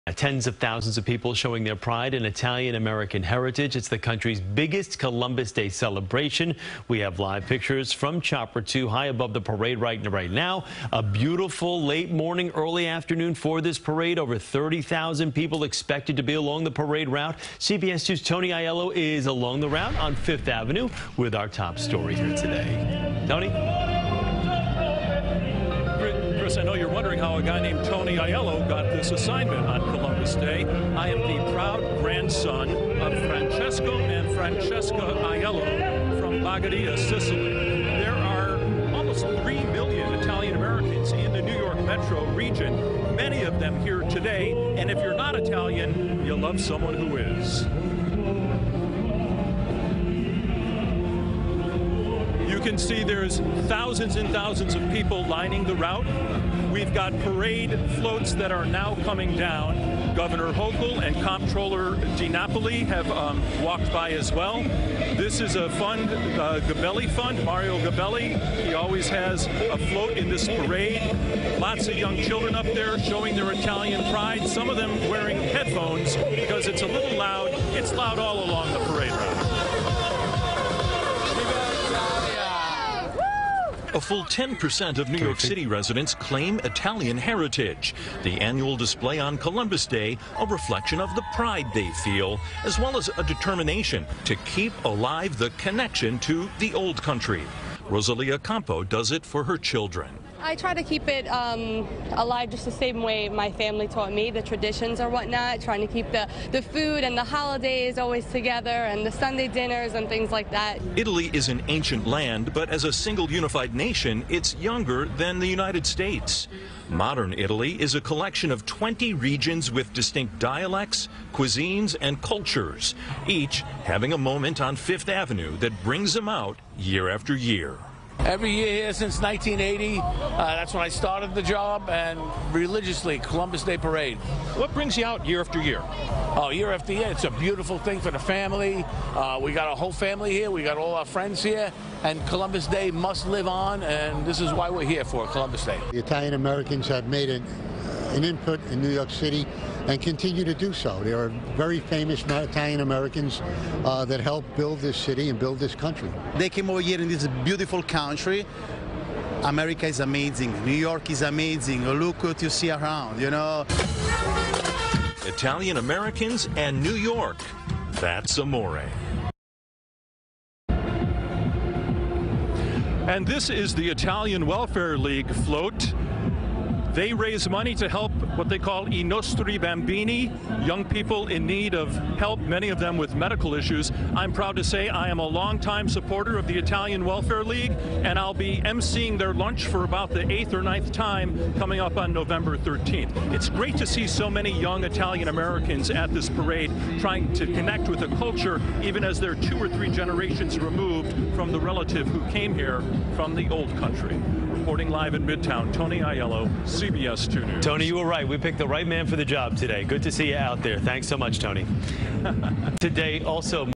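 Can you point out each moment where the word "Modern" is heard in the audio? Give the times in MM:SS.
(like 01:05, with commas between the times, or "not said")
01:56.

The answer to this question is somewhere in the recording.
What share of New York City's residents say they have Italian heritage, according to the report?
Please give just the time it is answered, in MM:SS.
01:24.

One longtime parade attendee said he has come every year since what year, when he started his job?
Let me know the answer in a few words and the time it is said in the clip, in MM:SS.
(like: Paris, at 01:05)
1980, at 02:09.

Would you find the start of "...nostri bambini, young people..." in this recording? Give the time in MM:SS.
02:59.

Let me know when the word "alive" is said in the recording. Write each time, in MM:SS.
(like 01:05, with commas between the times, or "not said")
01:34, 01:42.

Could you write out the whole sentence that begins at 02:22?
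And Columbus Day must live on, and this is why we're here for Columbus Day.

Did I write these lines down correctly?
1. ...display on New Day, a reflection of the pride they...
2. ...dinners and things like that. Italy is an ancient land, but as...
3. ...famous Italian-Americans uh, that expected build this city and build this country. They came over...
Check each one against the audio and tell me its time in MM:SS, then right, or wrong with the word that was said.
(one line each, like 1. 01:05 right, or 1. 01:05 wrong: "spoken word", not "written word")
1. 01:28 wrong: "Columbus", not "New"
2. 01:49 right
3. 02:31 wrong: "helped", not "expected".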